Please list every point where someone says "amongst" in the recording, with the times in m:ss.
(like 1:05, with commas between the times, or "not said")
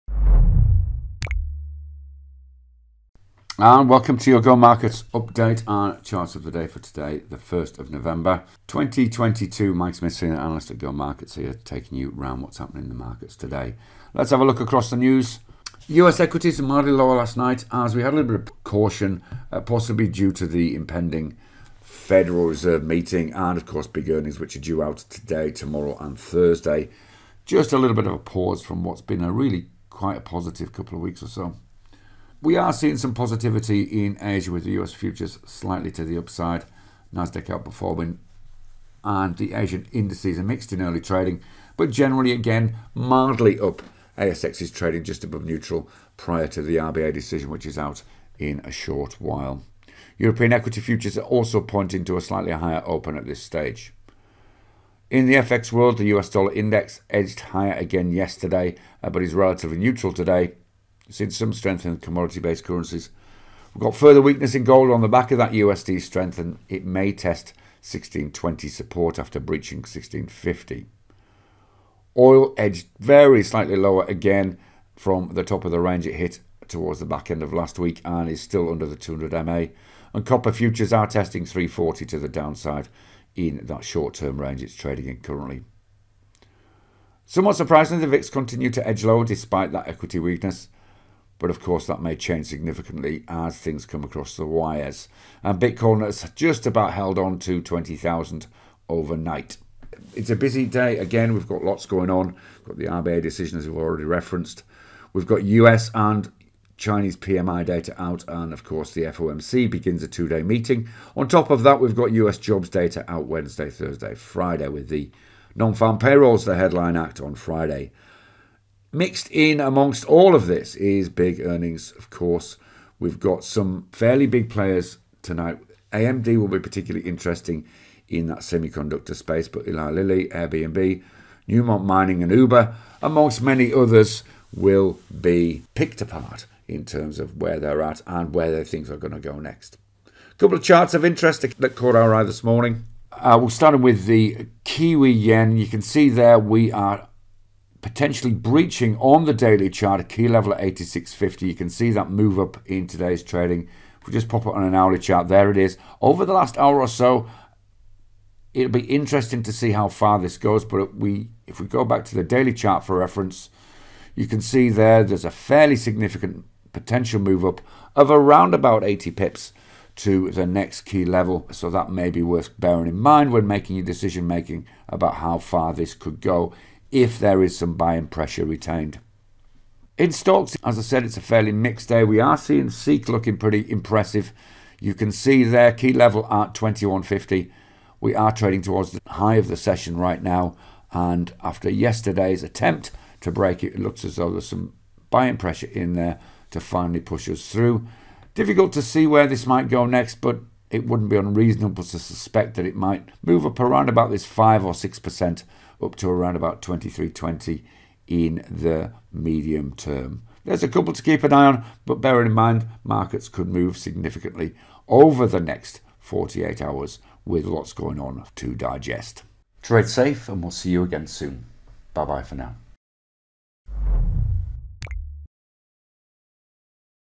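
1:59, 2:13.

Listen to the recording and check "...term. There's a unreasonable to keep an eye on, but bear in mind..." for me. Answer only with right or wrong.
wrong.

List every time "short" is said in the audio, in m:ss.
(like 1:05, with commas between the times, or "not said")
0:48, 1:23.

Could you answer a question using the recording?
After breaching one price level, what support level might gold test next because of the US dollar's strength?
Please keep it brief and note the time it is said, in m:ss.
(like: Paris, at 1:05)
1620, at 1:07.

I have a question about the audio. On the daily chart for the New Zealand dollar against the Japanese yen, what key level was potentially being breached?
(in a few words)
86.50.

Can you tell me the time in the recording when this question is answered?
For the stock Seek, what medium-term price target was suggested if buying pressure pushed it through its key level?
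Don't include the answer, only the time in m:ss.
3:26.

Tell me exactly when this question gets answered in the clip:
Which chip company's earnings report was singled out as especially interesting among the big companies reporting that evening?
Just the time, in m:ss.
2:05.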